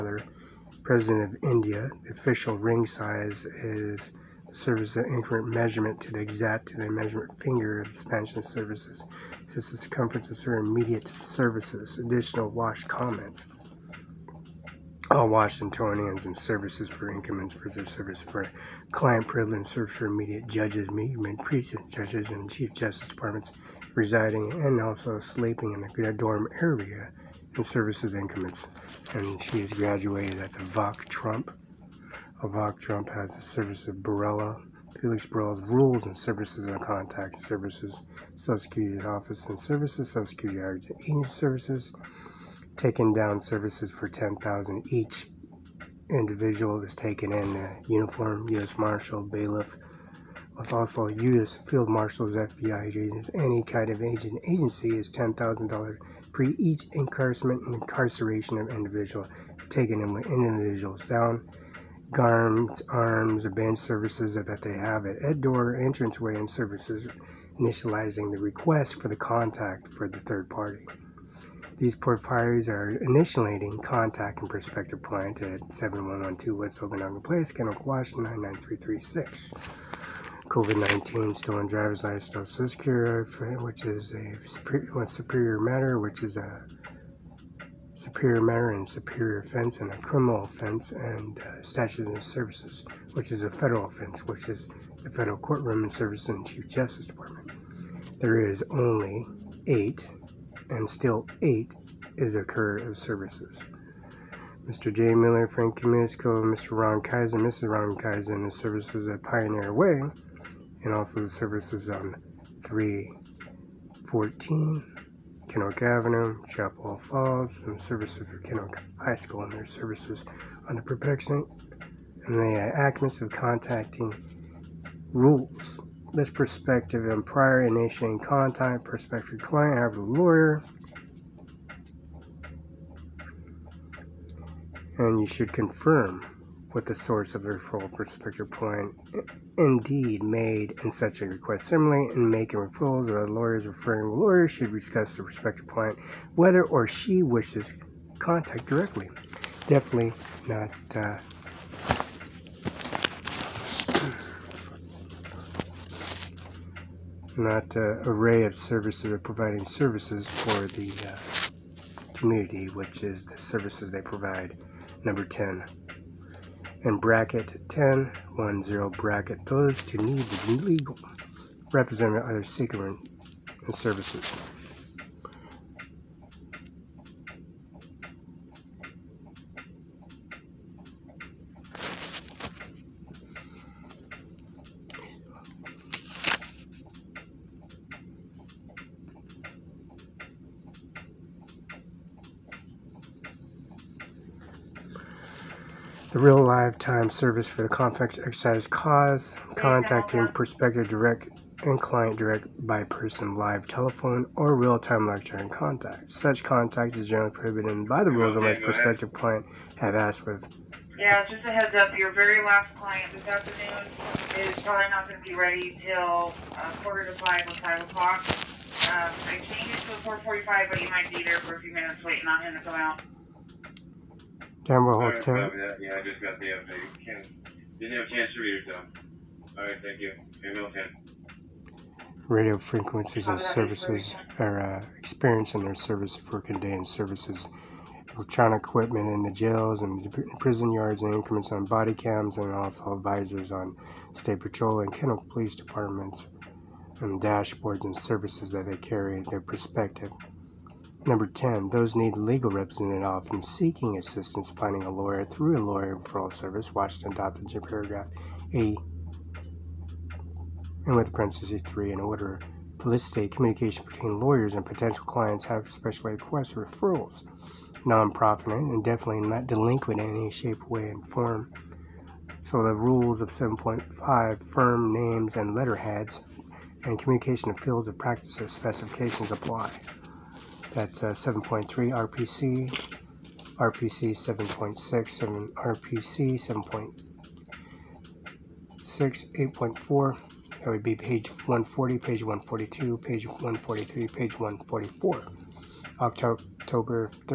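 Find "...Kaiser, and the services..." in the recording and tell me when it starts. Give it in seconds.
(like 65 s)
107 s.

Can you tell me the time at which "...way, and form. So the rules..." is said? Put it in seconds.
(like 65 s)
270 s.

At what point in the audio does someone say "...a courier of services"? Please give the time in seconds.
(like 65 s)
102 s.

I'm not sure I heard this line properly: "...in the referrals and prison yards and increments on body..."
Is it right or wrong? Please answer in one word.
wrong.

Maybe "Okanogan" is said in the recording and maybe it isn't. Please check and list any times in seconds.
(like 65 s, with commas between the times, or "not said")
76 s.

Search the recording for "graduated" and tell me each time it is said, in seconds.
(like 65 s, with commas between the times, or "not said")
29 s.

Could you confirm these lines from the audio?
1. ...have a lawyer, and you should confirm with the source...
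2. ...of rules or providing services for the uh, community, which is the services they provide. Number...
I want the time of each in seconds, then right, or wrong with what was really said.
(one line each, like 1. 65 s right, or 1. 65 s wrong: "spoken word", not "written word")
1. 129 s right
2. 158 s wrong: "services", not "rules".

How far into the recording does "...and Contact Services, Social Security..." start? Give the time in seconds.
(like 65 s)
36 s.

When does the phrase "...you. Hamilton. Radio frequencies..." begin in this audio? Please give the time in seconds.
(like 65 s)
229 s.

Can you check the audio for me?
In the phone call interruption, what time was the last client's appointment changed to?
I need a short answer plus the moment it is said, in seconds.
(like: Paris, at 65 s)
4:45, at 220 s.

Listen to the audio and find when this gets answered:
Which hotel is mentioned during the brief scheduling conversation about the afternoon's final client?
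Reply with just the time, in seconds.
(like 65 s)
224 s.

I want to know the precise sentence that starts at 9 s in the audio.
This is the circumference of certain immediate services, additional wash comments.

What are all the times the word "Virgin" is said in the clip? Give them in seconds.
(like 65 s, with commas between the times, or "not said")
not said.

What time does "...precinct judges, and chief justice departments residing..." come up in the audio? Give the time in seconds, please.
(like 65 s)
21 s.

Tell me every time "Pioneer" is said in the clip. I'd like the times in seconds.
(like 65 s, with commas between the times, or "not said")
109 s.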